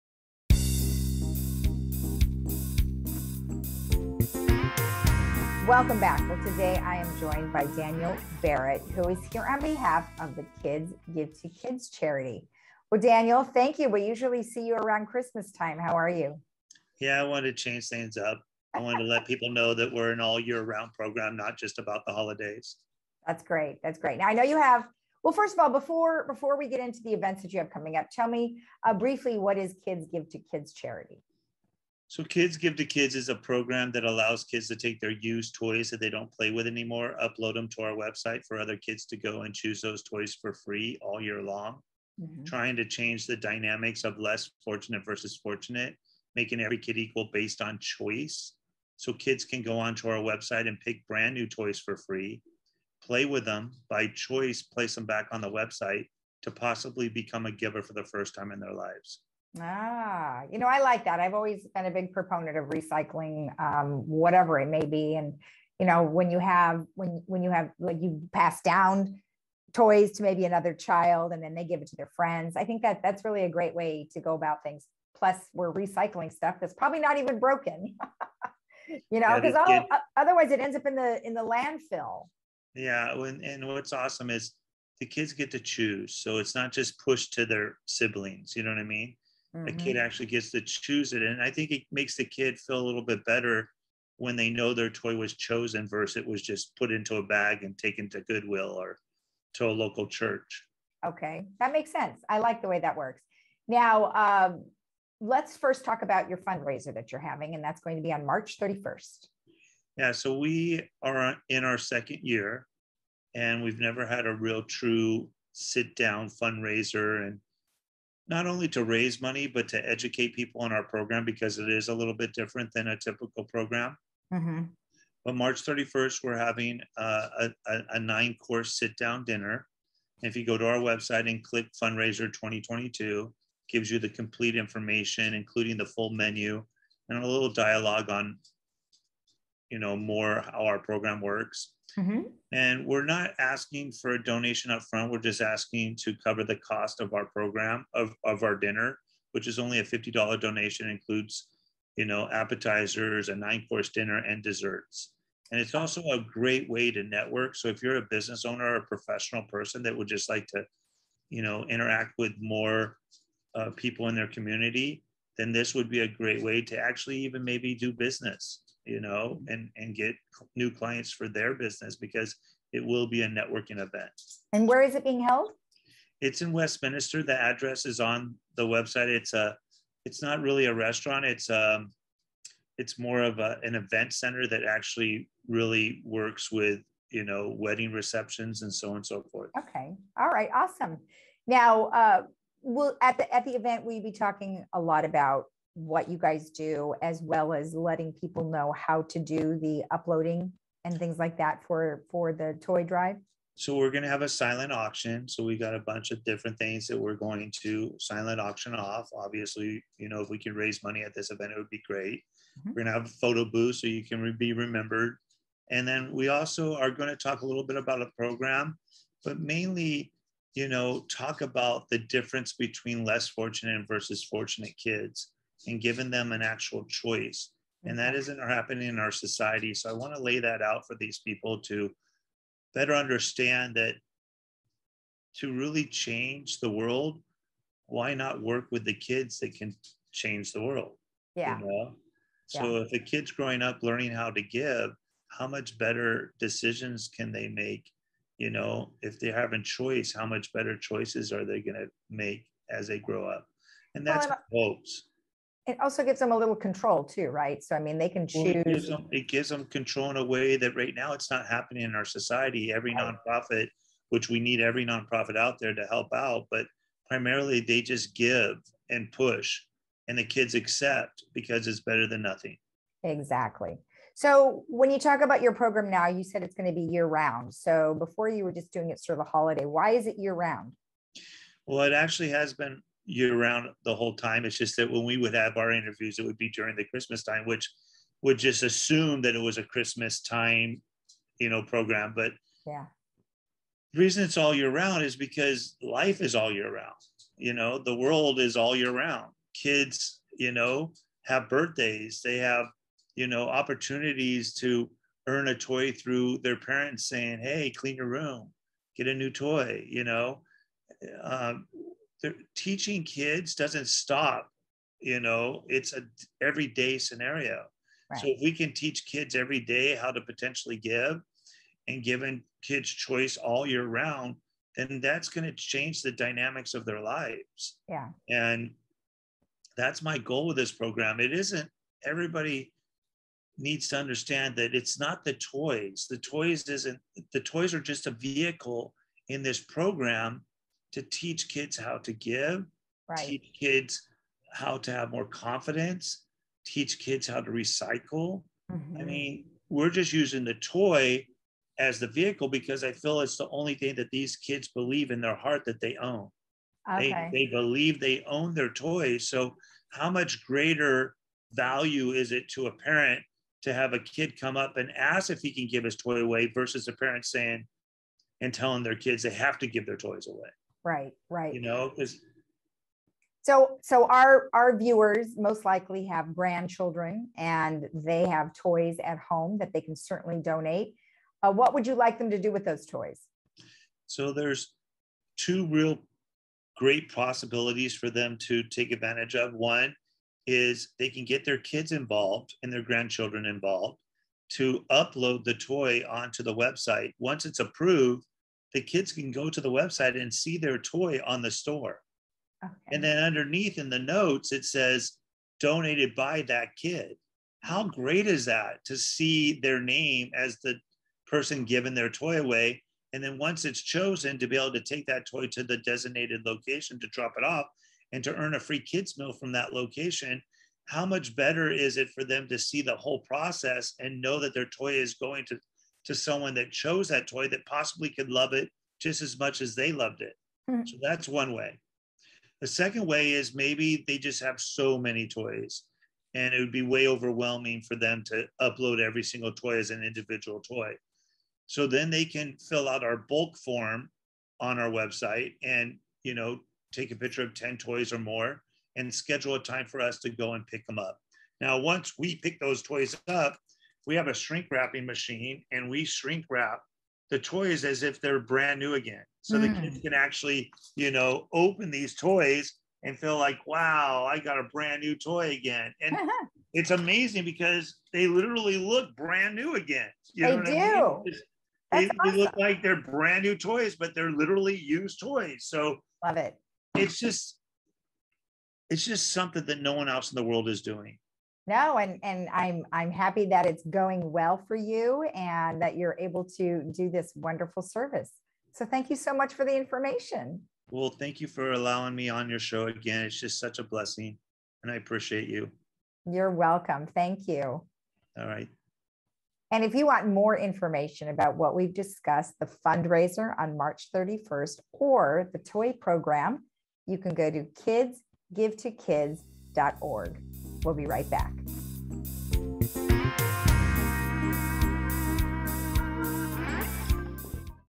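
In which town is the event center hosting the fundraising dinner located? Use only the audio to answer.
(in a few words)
Westminster.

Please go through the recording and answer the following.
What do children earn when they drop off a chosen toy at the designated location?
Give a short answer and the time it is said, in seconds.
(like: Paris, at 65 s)
free kids meal, at 418 s.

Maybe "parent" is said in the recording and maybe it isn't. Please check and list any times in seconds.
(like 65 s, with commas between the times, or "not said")
306 s, 362 s, 366 s.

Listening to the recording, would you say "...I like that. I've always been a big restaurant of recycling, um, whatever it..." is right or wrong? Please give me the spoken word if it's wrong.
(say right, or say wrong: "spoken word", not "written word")
wrong: "proponent", not "restaurant".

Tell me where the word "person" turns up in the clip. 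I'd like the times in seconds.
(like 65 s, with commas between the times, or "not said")
159 s, 411 s.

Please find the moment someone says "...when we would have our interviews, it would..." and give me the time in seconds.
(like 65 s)
284 s.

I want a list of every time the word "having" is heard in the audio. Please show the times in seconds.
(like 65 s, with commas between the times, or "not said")
107 s, 126 s.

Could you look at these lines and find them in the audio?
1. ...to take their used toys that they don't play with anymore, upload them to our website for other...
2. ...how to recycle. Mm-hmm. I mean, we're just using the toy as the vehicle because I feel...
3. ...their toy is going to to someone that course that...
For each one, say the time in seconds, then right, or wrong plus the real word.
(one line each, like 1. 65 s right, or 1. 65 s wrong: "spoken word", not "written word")
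1. 34 s right
2. 347 s right
3. 424 s wrong: "chose", not "course".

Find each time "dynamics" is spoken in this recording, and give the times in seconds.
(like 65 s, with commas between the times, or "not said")
43 s, 326 s.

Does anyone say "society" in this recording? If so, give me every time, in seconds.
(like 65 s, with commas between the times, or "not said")
229 s, 262 s.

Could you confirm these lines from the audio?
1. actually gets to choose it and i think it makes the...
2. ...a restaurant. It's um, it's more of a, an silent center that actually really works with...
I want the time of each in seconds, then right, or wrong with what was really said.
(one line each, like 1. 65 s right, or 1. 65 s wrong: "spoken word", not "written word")
1. 90 s right
2. 180 s wrong: "event", not "silent".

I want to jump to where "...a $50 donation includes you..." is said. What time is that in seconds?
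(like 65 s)
149 s.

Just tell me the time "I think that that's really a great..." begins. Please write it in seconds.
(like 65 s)
72 s.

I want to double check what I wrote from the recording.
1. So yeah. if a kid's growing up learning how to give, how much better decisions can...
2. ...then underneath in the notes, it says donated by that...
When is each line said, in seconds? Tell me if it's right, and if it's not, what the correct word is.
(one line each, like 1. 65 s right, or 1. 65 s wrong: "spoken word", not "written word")
1. 242 s right
2. 403 s right.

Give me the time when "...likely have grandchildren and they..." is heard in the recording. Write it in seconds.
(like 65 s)
375 s.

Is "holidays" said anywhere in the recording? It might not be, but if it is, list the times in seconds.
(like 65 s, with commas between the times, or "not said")
22 s, 279 s.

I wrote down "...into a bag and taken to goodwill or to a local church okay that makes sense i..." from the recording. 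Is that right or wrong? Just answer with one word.
right.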